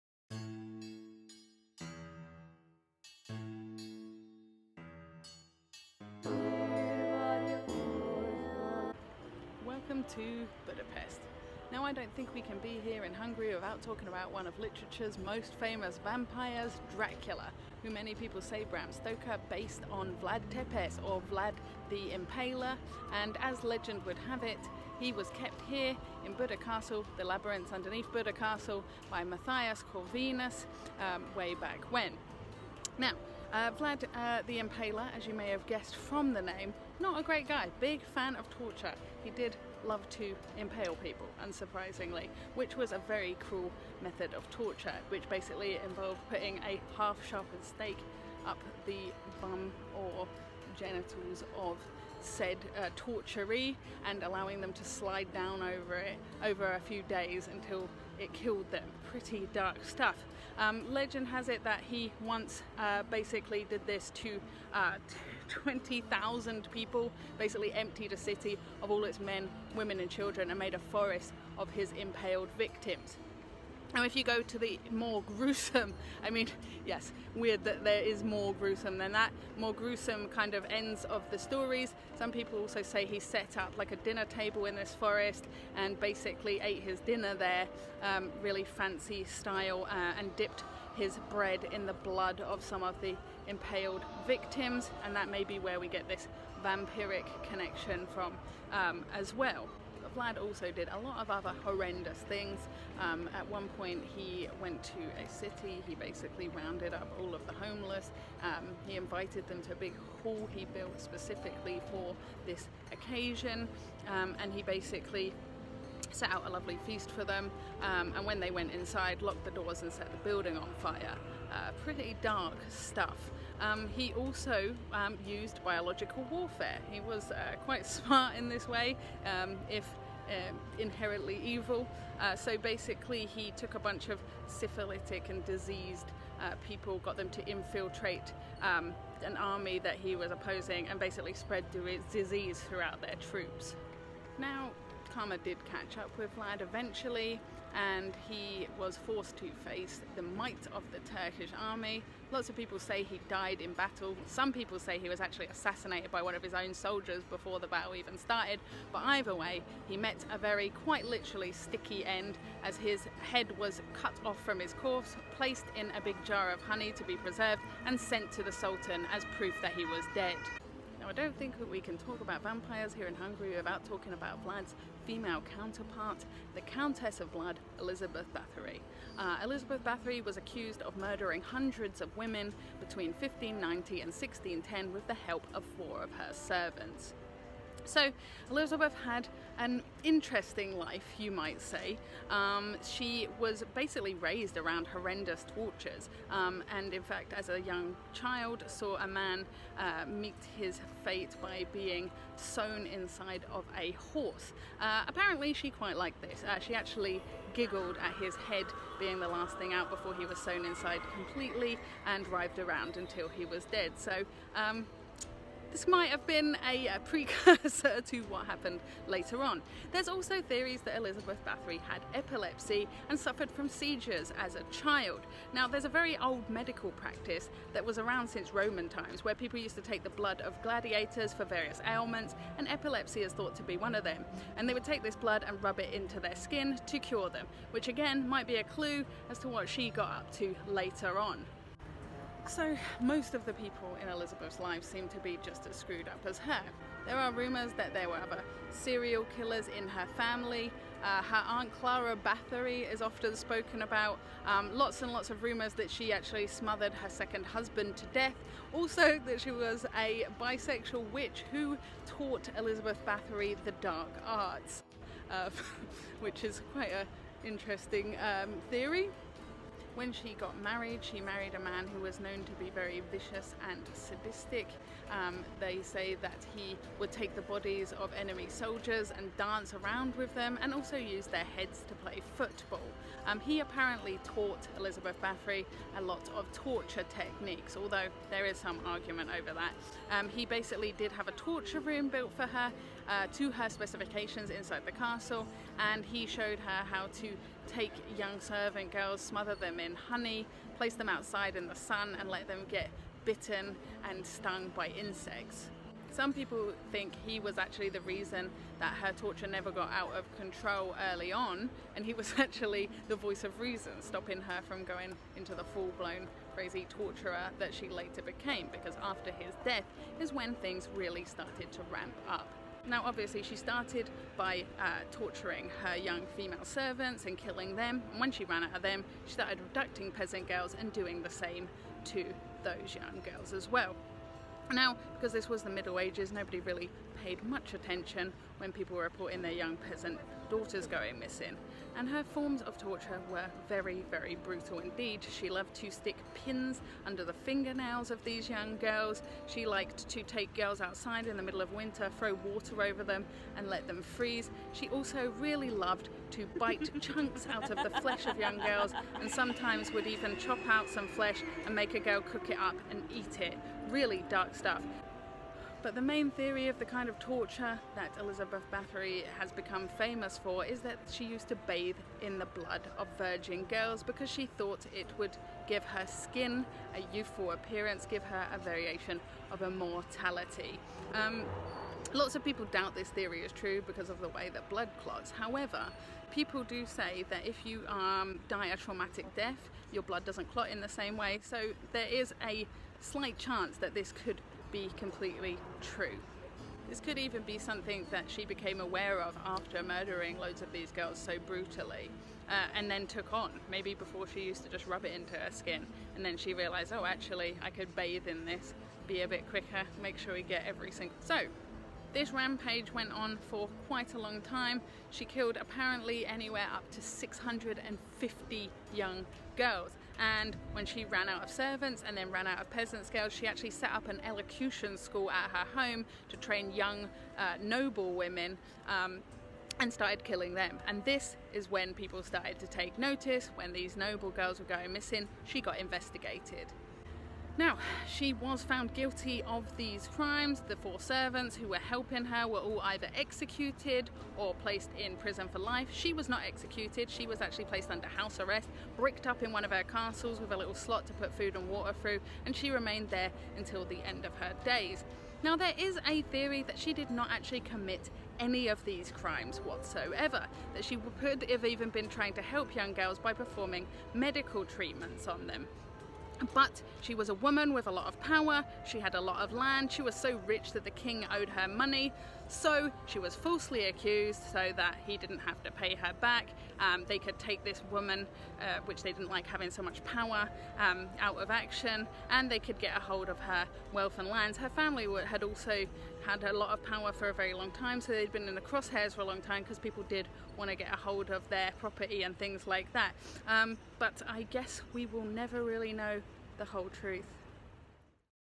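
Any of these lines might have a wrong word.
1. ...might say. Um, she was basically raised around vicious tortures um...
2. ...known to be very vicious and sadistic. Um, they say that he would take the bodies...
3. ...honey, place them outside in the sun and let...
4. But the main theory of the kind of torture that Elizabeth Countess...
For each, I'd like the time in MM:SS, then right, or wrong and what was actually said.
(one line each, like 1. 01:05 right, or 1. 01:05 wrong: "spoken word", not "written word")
1. 03:11 wrong: "horrendous", not "vicious"
2. 04:32 right
3. 04:59 right
4. 06:05 wrong: "Bathory", not "Countess".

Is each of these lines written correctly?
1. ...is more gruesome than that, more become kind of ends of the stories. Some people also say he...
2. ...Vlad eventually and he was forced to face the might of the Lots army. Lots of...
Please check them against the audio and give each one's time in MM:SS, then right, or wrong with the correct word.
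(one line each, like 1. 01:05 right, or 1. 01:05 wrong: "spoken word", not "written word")
1. 01:18 wrong: "gruesome", not "become"
2. 02:26 wrong: "Turkish", not "Lots".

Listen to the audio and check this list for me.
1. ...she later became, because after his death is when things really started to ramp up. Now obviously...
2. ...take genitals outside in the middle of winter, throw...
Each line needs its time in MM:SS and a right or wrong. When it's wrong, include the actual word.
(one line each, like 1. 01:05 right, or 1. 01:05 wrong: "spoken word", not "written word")
1. 05:17 right
2. 05:50 wrong: "girls", not "genitals".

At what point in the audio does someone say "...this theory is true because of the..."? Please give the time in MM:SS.
06:22.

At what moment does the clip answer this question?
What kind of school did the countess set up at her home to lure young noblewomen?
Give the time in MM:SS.
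07:04.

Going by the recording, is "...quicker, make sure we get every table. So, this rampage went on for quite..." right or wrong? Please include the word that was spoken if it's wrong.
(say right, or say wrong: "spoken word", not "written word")
wrong: "single", not "table".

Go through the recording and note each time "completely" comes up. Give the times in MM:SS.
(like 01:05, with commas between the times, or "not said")
03:31, 06:34.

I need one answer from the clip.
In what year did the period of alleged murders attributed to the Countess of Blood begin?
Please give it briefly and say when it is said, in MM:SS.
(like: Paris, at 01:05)
1590, at 03:03.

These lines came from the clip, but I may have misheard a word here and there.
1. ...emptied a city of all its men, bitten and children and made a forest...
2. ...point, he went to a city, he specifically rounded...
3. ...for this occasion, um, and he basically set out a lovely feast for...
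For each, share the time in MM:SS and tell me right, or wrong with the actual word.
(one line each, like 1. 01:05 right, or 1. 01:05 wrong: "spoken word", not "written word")
1. 01:07 wrong: "women", not "bitten"
2. 01:43 wrong: "basically", not "specifically"
3. 01:51 right.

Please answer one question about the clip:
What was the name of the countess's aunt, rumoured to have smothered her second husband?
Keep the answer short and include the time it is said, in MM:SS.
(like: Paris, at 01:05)
Clara Bathory, at 04:11.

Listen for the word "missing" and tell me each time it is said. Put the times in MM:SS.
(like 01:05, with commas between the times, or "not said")
05:41, 07:14.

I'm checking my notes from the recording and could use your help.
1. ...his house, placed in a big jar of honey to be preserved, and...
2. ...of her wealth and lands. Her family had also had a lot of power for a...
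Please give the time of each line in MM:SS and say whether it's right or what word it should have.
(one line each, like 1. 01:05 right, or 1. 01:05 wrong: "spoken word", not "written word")
1. 02:44 wrong: "corpse", not "house"
2. 08:03 right.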